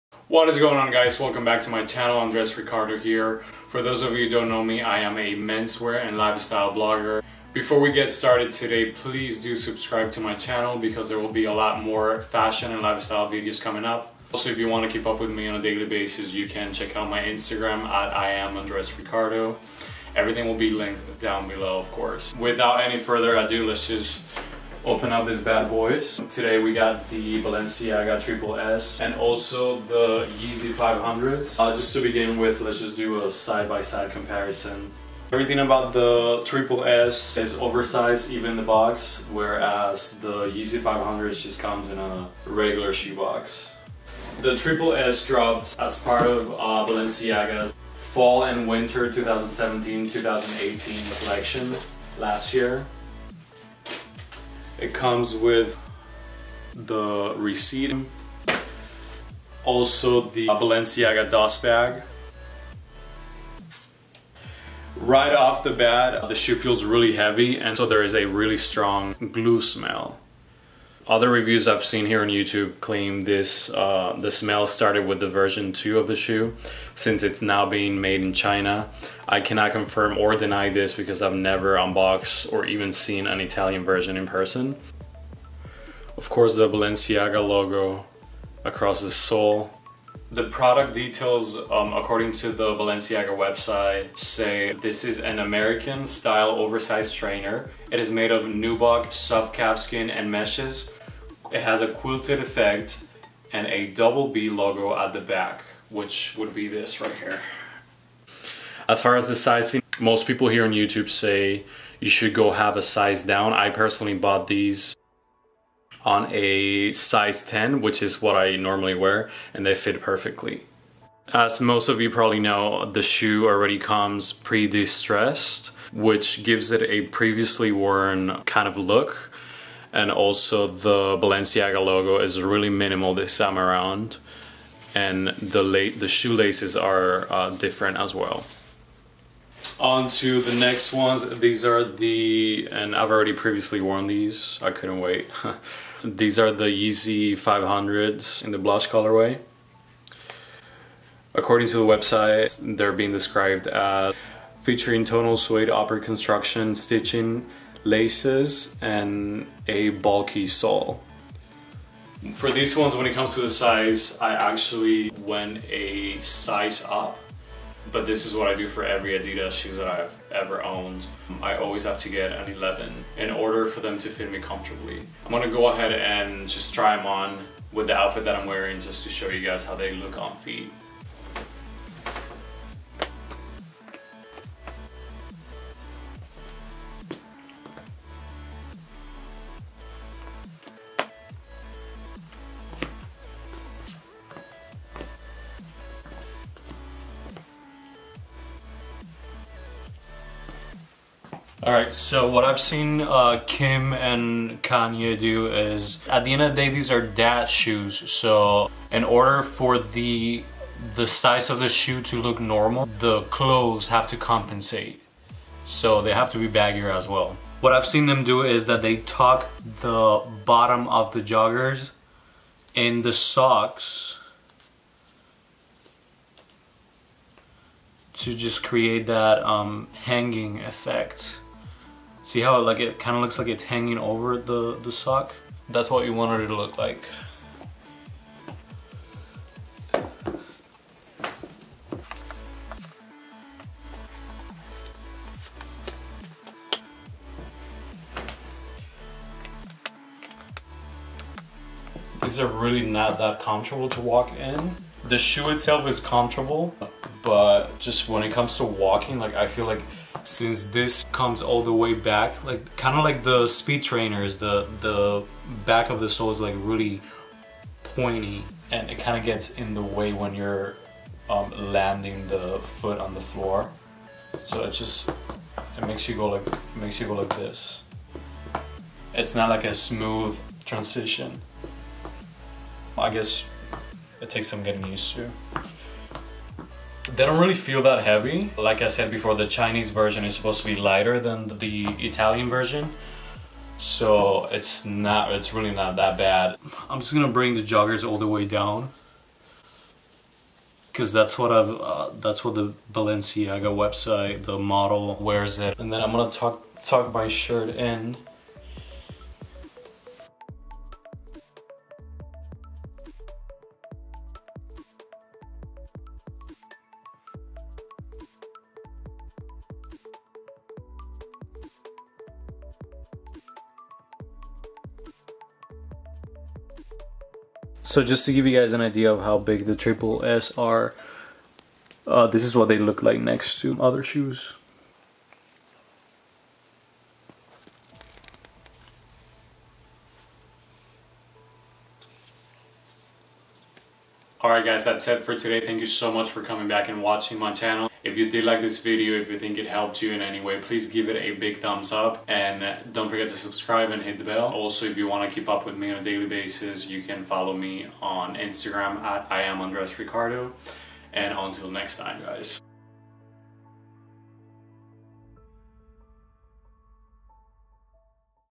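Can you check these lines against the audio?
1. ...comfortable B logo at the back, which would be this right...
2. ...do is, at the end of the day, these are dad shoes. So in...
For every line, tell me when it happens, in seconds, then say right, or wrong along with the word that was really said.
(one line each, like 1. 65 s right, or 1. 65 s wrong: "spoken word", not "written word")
1. 103 s wrong: "double", not "comfortable"
2. 205 s right.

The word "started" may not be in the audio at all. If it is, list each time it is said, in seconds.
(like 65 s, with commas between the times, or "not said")
8 s, 74 s.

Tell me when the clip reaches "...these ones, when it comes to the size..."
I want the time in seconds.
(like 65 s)
162 s.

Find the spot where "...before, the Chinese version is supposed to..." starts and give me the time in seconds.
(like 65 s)
289 s.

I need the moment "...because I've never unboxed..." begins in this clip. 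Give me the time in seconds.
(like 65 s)
80 s.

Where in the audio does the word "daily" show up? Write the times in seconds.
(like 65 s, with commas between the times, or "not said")
15 s, 356 s.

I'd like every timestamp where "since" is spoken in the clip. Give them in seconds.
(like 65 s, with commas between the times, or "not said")
76 s, 260 s.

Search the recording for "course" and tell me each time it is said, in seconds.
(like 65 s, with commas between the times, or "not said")
21 s, 86 s.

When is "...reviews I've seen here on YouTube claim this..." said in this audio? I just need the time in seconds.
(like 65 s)
71 s.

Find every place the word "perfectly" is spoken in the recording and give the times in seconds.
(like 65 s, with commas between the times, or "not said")
120 s.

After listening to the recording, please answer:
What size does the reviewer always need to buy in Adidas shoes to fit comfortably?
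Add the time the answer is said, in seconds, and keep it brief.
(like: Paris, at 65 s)
11, at 172 s.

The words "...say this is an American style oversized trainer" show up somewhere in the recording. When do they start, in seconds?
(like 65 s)
94 s.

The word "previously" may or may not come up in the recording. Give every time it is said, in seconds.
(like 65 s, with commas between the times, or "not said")
127 s, 143 s.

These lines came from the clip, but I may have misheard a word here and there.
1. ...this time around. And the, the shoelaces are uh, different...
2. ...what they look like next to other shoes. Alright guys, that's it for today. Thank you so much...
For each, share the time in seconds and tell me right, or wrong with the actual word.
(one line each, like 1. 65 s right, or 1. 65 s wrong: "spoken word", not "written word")
1. 133 s right
2. 332 s right.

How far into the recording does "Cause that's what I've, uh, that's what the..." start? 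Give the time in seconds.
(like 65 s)
300 s.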